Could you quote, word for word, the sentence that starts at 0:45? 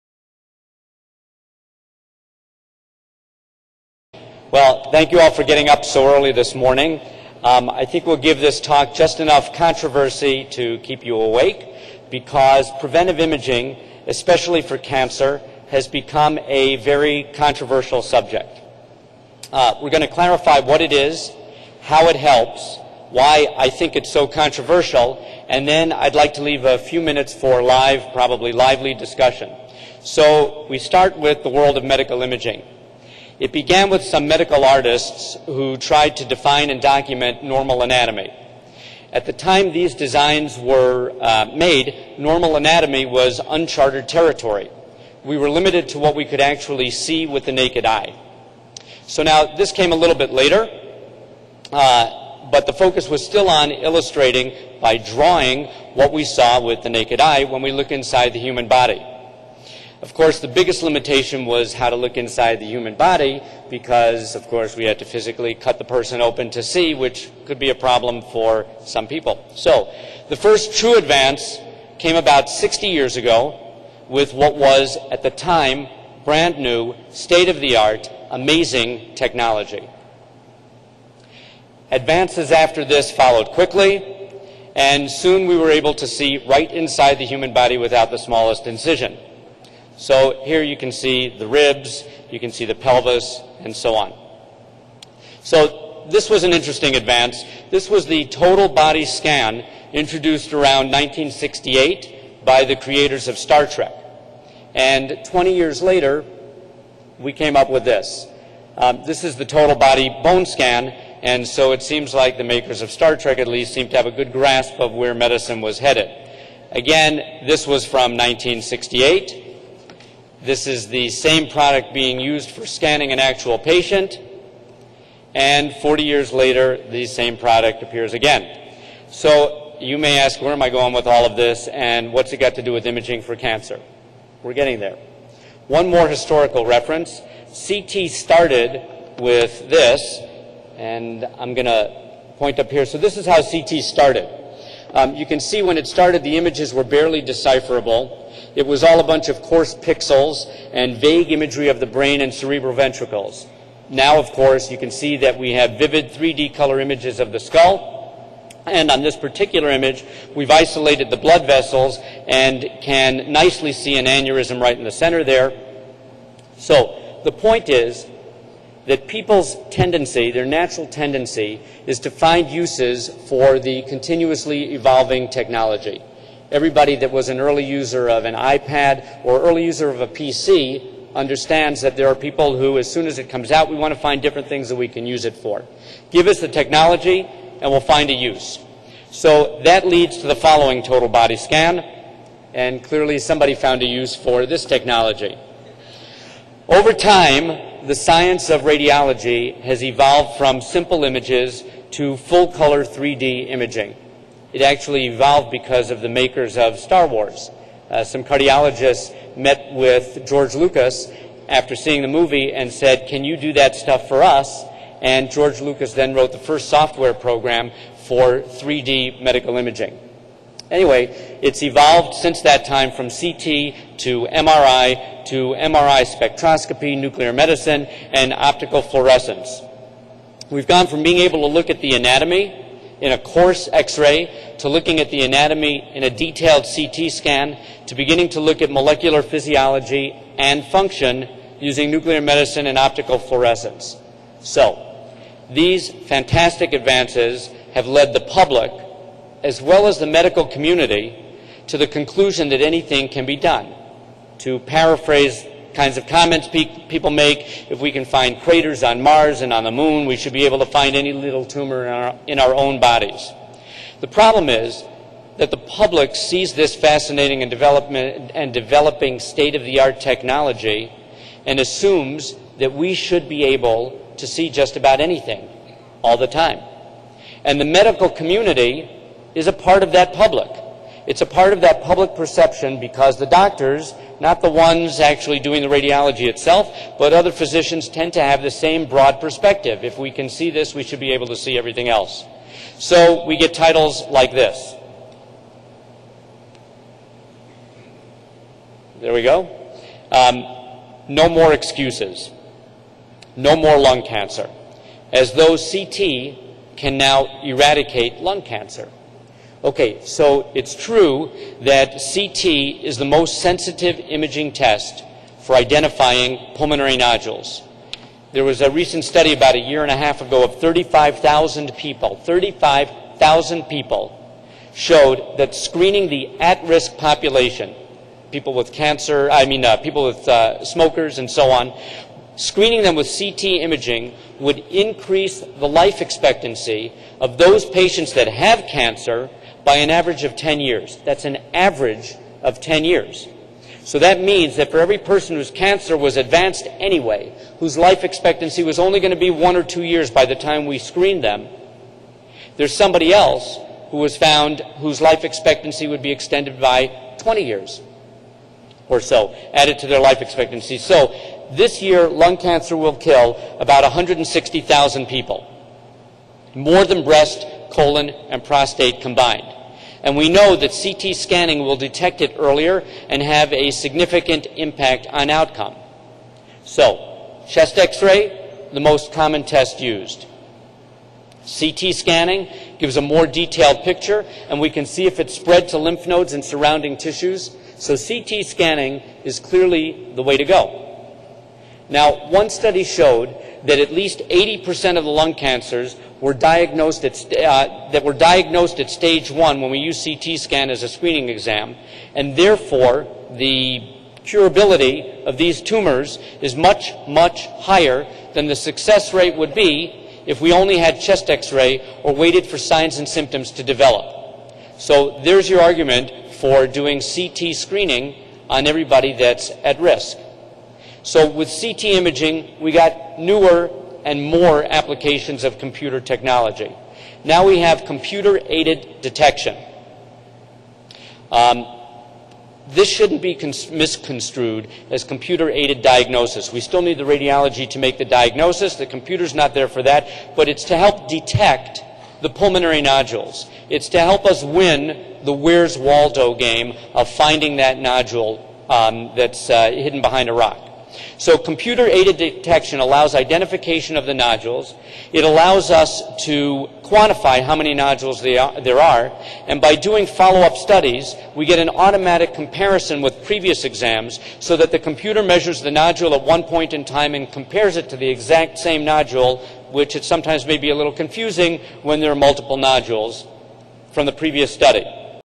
We were limited to what we could actually see with the naked eye.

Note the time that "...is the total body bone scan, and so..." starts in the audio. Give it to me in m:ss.
1:49.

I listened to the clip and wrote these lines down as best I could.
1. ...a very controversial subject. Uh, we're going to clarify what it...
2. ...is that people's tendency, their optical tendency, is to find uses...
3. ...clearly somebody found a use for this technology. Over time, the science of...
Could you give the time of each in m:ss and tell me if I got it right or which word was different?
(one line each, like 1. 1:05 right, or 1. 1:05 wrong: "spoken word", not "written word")
1. 0:16 right
2. 2:47 wrong: "natural", not "optical"
3. 3:12 right.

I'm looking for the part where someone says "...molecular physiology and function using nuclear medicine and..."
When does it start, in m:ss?
3:58.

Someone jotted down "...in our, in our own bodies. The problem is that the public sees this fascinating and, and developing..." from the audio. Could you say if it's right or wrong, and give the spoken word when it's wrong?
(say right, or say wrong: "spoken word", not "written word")
right.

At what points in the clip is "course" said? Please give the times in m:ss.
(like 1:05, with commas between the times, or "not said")
1:00, 1:04, 2:34.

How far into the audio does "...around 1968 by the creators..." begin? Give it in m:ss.
1:40.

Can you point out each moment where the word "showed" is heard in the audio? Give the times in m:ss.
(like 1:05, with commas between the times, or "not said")
5:24, 6:32.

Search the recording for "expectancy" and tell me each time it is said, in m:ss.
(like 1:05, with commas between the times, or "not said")
5:36, 5:48, 5:55, 6:00.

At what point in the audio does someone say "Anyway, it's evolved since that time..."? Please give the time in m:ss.
3:40.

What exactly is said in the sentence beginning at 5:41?
That's an average of 10 years.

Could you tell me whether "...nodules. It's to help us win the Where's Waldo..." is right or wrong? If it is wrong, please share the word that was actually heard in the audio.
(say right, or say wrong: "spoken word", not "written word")
right.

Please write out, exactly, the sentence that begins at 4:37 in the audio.
And the medical community is a part of that public.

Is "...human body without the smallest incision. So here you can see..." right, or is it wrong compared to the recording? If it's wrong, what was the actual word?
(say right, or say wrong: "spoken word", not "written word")
right.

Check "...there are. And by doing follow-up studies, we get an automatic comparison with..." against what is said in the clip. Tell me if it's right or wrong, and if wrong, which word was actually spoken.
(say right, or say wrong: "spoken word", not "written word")
right.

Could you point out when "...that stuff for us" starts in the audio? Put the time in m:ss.
3:33.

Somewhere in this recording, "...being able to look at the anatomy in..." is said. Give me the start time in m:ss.
3:51.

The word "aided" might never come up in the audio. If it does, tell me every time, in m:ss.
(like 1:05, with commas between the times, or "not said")
7:07, 7:15, 7:31.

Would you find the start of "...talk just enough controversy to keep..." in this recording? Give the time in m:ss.
0:08.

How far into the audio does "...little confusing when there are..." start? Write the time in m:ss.
7:50.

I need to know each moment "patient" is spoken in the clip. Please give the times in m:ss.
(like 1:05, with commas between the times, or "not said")
2:03, 5:37.